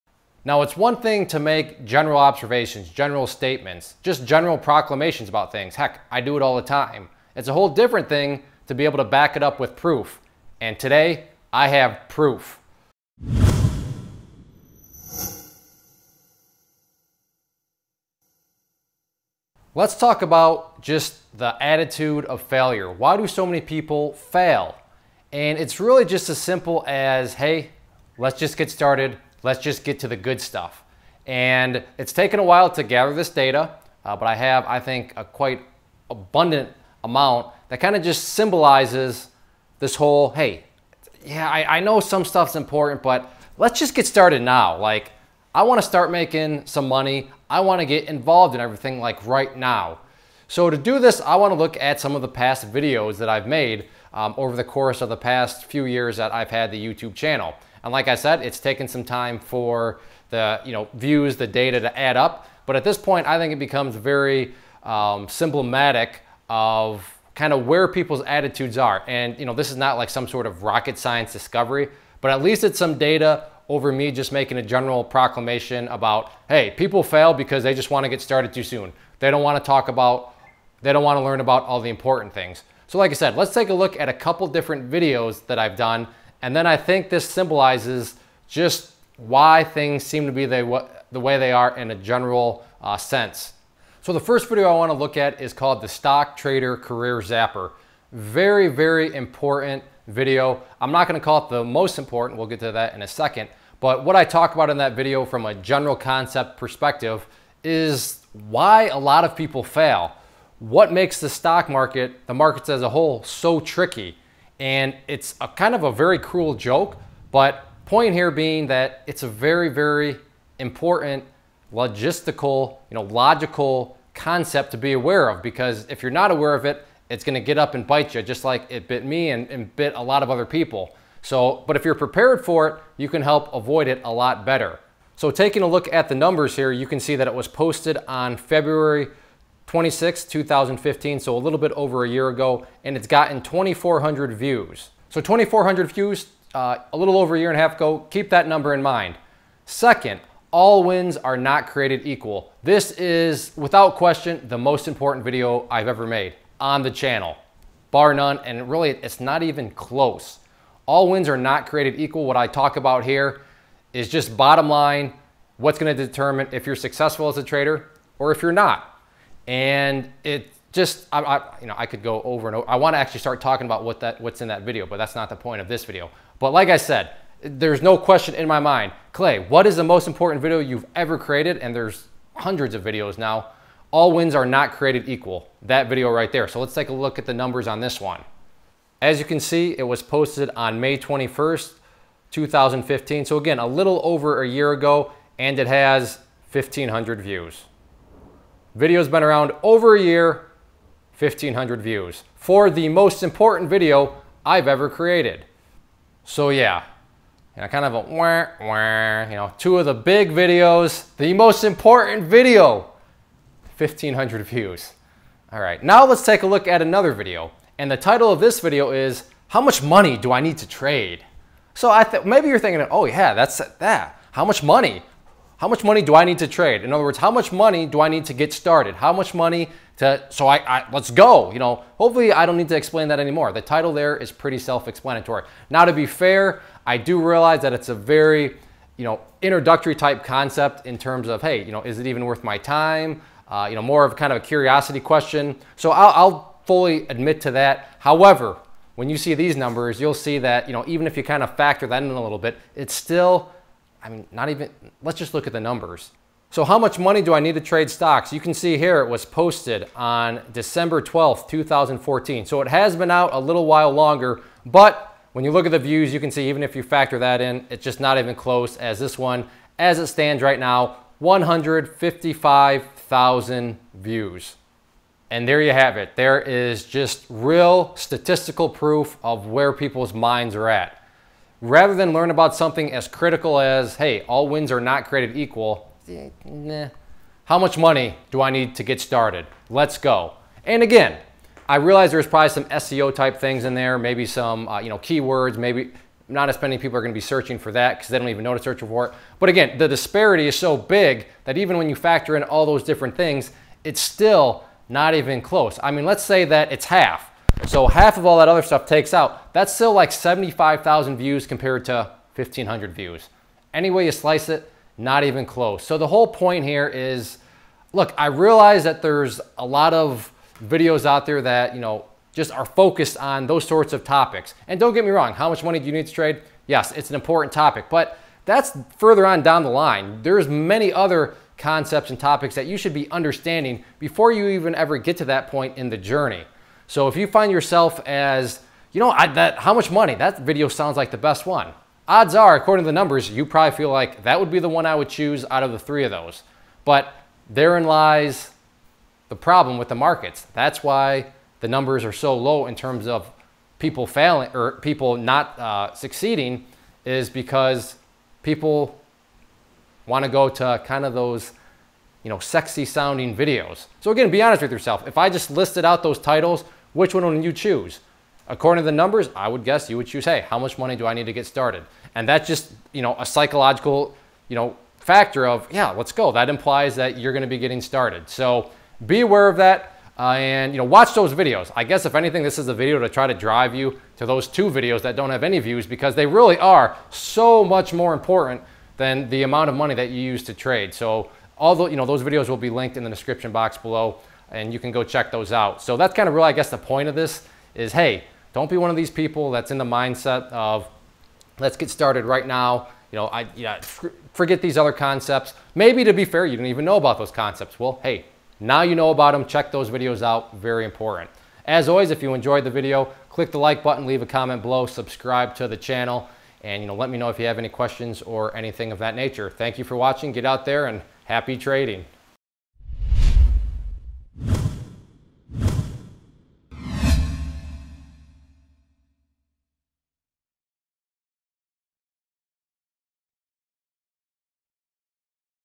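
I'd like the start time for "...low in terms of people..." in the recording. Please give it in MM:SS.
05:52.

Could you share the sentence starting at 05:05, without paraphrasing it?
I mean, let's say that it's half.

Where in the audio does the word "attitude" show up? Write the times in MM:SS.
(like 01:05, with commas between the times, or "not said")
00:21, 01:08.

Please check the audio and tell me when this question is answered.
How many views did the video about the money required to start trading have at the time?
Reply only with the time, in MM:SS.
04:31.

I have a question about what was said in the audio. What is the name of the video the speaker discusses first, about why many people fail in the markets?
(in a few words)
Stock Trader Career Zapper.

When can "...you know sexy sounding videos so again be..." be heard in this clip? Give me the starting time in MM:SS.
06:02.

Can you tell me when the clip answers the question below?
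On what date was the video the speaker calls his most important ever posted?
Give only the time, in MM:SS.
03:10.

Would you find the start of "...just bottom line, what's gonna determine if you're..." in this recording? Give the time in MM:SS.
02:44.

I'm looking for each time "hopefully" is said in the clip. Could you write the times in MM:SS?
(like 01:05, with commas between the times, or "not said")
03:51.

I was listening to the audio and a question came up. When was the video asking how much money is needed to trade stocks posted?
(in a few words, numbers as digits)
December 12th, 2014.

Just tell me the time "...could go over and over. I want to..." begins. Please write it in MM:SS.
02:51.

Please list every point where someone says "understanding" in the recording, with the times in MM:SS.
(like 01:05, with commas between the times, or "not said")
05:33.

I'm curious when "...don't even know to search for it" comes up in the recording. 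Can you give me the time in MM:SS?
04:58.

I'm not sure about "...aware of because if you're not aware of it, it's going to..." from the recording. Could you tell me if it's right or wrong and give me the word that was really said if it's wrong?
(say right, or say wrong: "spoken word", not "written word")
right.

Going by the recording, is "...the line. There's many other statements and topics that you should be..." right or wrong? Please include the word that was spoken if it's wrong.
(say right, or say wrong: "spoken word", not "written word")
wrong: "concepts", not "statements".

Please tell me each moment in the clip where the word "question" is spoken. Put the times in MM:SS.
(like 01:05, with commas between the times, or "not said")
02:33, 02:57, 04:04, 06:57.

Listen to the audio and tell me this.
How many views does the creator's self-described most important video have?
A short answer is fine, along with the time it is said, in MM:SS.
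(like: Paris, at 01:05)
1,500, at 03:15.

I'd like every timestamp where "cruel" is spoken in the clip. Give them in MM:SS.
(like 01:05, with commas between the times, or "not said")
01:56.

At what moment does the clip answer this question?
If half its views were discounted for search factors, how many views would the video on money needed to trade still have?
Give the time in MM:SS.
05:10.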